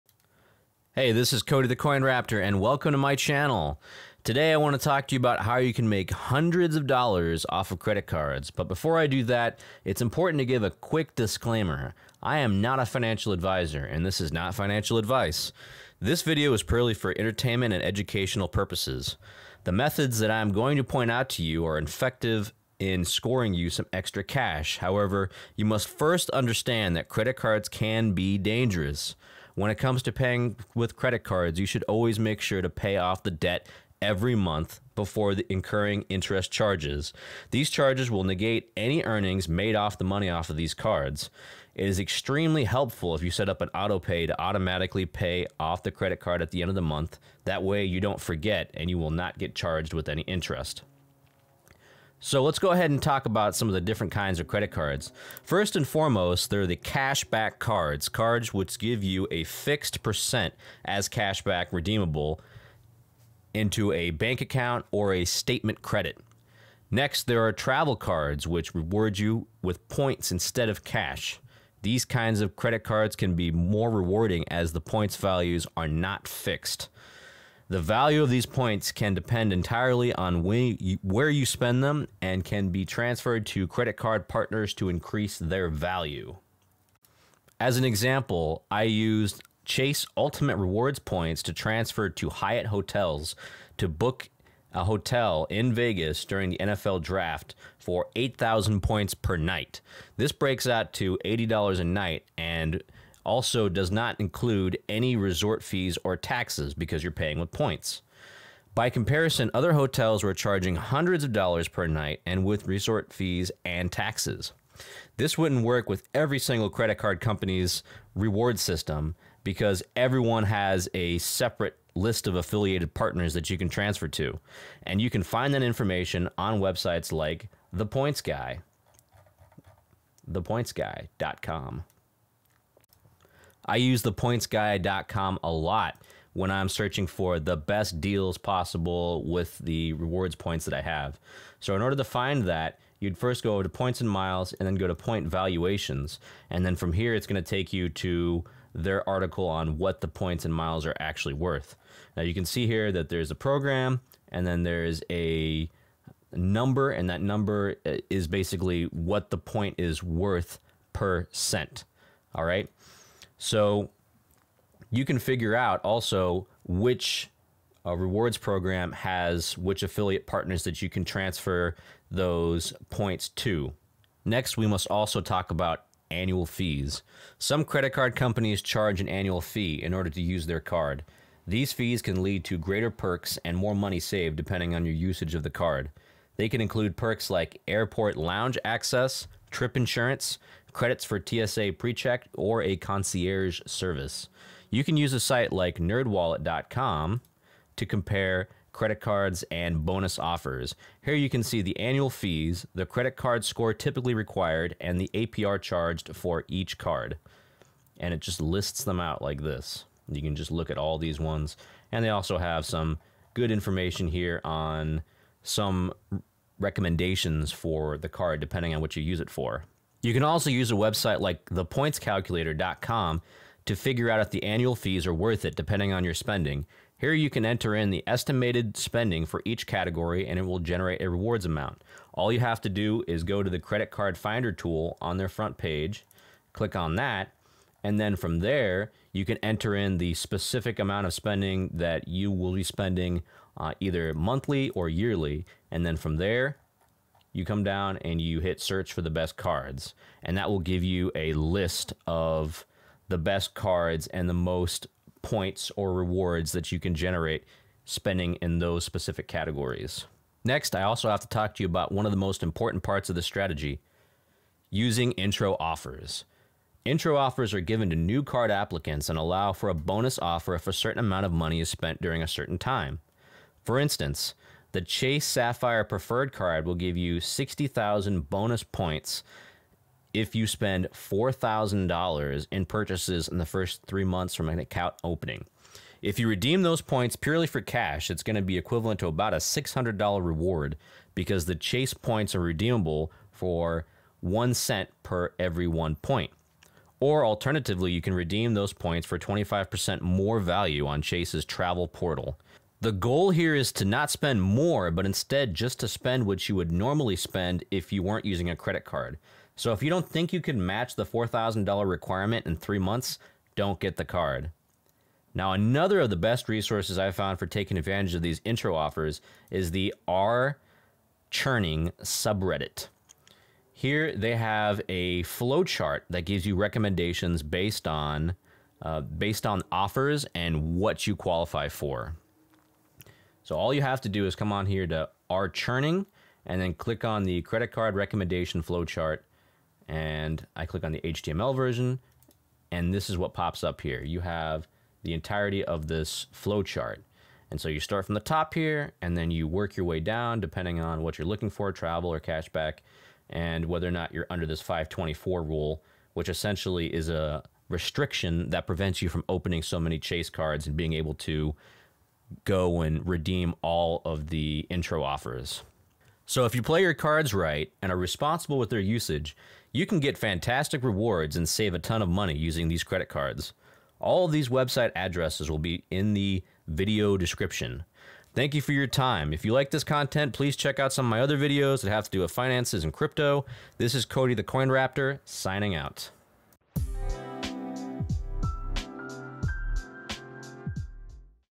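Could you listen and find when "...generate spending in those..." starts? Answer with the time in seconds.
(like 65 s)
256 s.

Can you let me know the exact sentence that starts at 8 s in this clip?
But before I do that, it's important to give a quick disclaimer.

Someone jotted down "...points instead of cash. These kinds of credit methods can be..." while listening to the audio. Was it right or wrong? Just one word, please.
wrong.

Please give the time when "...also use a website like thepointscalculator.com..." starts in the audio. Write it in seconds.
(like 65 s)
220 s.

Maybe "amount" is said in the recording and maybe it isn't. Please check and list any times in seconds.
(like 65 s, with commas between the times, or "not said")
231 s, 240 s, 270 s.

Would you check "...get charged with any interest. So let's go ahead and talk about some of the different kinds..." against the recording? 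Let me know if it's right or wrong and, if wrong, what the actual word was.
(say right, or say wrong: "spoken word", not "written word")
right.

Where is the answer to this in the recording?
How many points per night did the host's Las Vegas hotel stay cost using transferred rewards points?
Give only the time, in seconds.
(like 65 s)
98 s.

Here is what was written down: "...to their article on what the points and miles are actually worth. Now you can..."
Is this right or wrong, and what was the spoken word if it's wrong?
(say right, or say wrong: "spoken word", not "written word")
right.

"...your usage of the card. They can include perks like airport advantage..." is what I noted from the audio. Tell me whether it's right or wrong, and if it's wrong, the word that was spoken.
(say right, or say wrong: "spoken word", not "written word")
wrong: "lounge", not "advantage".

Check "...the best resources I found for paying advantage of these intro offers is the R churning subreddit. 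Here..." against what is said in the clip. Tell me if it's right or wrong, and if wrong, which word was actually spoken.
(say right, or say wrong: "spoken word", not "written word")
wrong: "taking", not "paying".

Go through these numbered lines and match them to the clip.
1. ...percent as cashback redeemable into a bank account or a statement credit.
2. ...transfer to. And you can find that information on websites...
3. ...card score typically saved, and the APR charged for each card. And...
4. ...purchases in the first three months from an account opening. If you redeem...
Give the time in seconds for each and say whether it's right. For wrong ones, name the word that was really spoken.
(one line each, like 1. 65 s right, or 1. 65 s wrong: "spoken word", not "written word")
1. 60 s right
2. 123 s right
3. 203 s wrong: "required", not "saved"
4. 282 s right.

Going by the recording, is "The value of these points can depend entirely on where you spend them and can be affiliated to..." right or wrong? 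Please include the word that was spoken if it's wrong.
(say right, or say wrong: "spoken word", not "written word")
wrong: "transferred", not "affiliated".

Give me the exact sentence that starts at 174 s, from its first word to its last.
Next, we must also talk about annual fees.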